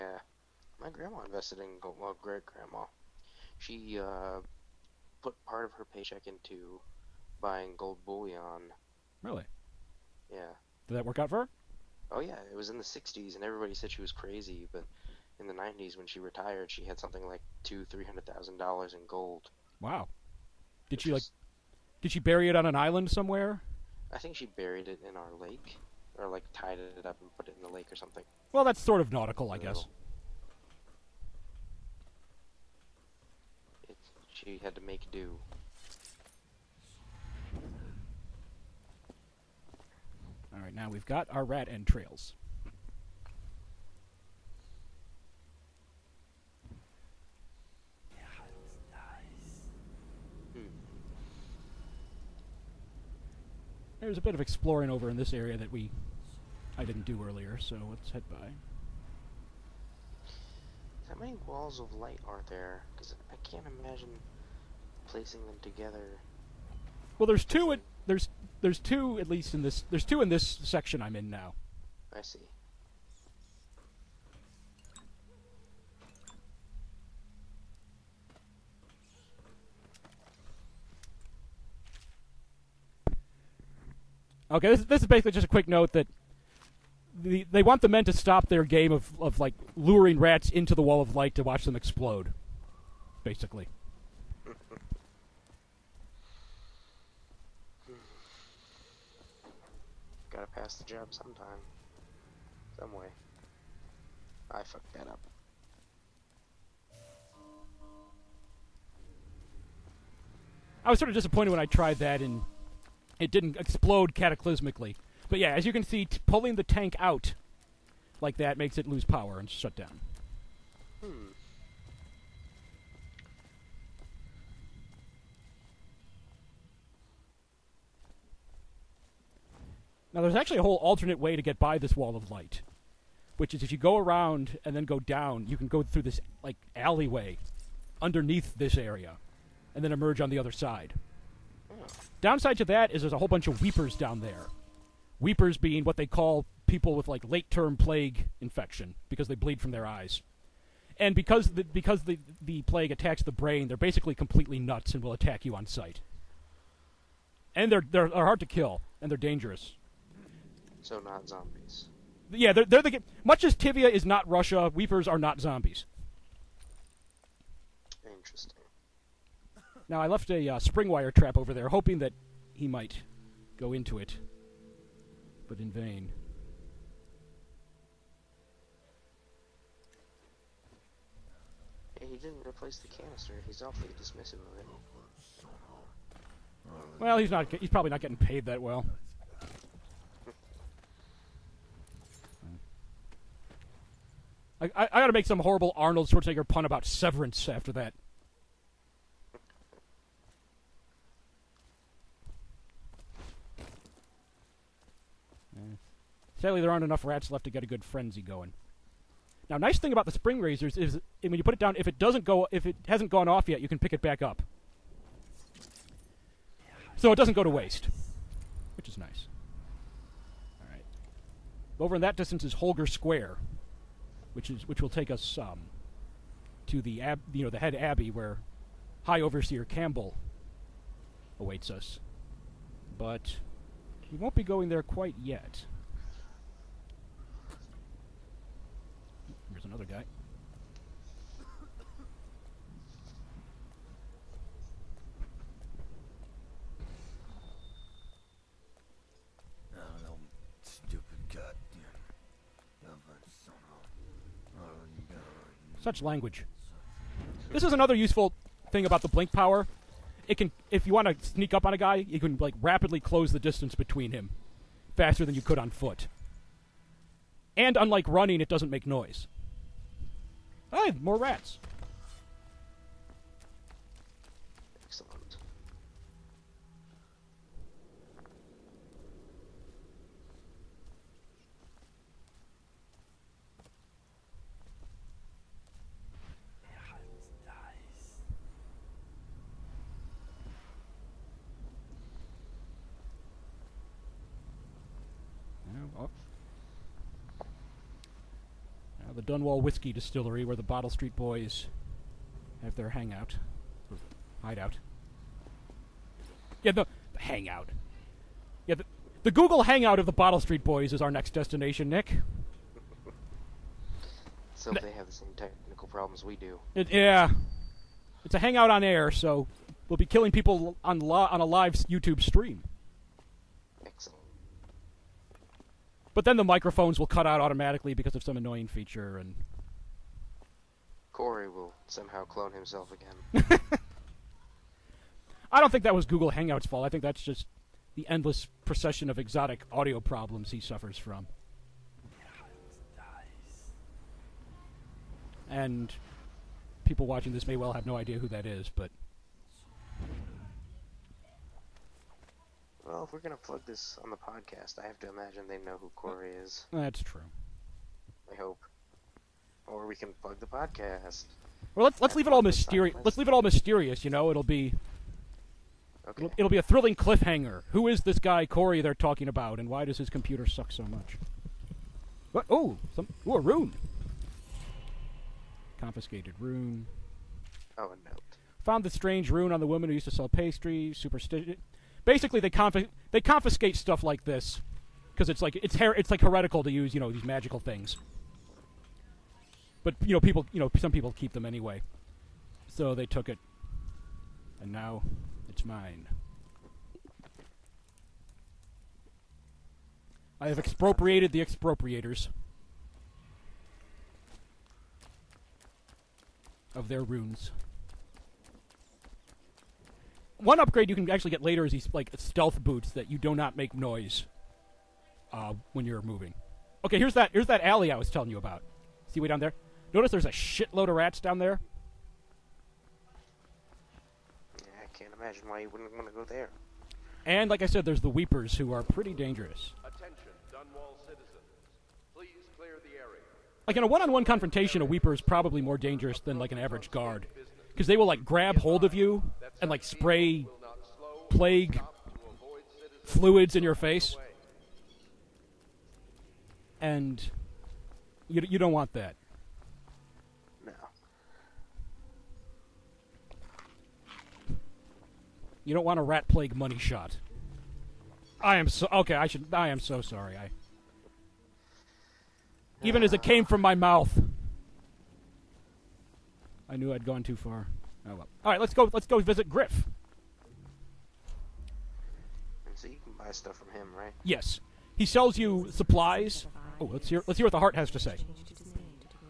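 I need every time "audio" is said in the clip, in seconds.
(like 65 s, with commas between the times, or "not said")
339 s.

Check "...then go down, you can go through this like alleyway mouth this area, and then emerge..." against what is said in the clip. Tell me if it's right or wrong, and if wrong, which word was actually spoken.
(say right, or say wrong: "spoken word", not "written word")
wrong: "underneath", not "mouth".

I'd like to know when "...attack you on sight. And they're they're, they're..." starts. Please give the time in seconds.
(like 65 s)
155 s.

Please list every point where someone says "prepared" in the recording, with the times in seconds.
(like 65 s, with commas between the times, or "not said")
not said.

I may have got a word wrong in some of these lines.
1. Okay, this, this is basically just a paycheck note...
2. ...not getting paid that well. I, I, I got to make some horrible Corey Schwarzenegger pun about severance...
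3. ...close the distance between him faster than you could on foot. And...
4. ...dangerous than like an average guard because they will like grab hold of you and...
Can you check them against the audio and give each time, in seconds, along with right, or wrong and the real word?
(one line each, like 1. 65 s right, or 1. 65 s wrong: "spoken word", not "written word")
1. 84 s wrong: "quick", not "paycheck"
2. 187 s wrong: "Arnold", not "Corey"
3. 262 s right
4. 435 s right.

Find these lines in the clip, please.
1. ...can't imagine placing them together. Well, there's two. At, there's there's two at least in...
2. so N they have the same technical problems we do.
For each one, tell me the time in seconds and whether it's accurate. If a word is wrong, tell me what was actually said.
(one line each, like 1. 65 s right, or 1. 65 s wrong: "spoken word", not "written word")
1. 63 s right
2. 314 s right.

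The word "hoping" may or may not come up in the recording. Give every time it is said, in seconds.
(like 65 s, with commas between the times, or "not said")
171 s.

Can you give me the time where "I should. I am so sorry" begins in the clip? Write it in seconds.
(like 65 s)
459 s.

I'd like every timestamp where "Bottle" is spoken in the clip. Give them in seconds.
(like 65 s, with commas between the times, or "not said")
300 s, 310 s.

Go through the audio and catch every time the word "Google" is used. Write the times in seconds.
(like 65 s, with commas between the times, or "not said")
309 s, 336 s.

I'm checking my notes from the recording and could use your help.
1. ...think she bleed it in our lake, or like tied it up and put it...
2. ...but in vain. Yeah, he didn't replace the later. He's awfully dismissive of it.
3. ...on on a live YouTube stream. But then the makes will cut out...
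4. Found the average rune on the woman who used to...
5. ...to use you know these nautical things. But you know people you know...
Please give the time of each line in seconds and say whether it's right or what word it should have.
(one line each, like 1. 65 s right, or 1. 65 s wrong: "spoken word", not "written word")
1. 24 s wrong: "buried", not "bleed"
2. 175 s wrong: "canister", not "later"
3. 320 s wrong: "microphones", not "makes"
4. 378 s wrong: "strange", not "average"
5. 386 s wrong: "magical", not "nautical".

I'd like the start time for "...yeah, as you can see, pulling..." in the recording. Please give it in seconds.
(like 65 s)
115 s.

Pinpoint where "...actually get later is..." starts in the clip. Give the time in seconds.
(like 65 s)
411 s.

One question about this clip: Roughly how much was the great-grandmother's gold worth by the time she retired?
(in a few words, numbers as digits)
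$200,000-300,000.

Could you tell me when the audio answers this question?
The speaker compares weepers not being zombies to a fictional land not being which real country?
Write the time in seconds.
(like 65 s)
163 s.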